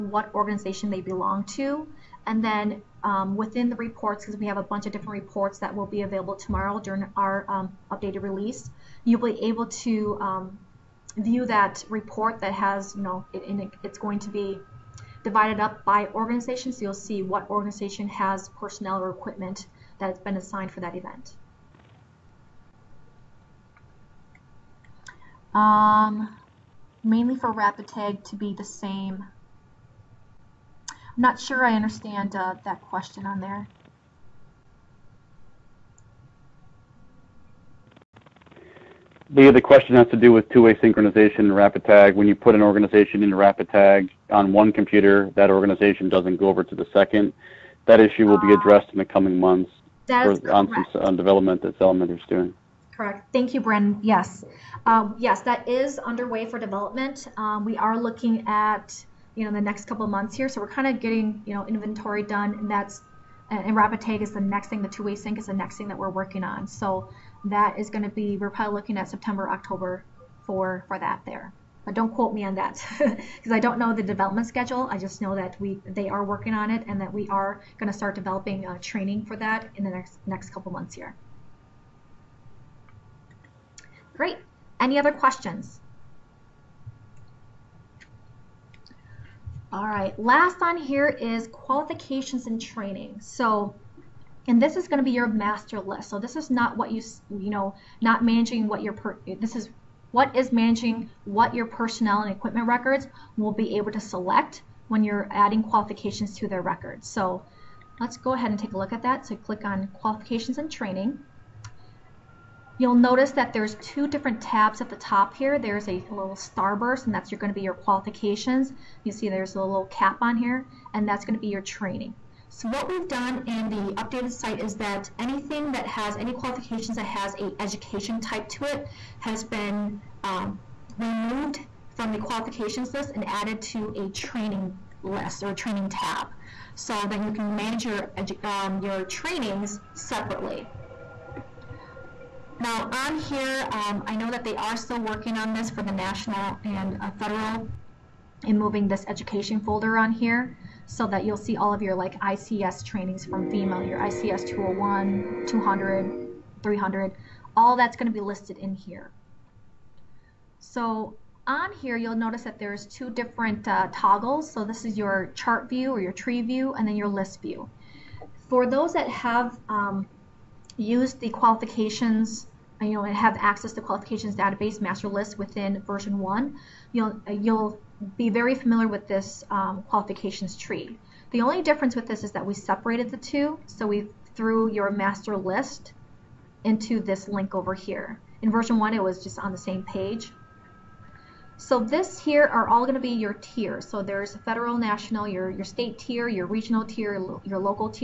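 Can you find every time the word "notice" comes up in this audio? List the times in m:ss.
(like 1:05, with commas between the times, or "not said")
1:53, 2:42.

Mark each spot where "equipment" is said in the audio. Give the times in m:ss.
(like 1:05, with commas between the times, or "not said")
0:19, 1:42.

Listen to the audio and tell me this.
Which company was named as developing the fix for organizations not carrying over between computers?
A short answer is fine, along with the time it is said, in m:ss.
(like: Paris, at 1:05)
Element, at 0:51.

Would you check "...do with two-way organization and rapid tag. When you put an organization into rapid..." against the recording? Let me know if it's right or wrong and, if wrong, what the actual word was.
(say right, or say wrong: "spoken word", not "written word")
wrong: "synchronization", not "organization".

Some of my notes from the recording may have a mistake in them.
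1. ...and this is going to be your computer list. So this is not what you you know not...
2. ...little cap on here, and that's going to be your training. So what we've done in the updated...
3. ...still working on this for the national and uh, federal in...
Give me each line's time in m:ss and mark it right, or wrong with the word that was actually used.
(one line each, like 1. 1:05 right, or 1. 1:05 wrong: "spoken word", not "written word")
1. 1:34 wrong: "master", not "computer"
2. 1:59 right
3. 2:24 right.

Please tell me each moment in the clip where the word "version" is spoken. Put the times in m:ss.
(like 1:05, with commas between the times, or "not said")
2:55, 3:08.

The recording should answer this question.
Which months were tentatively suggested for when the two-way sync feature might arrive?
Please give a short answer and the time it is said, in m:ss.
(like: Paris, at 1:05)
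September, October, at 1:09.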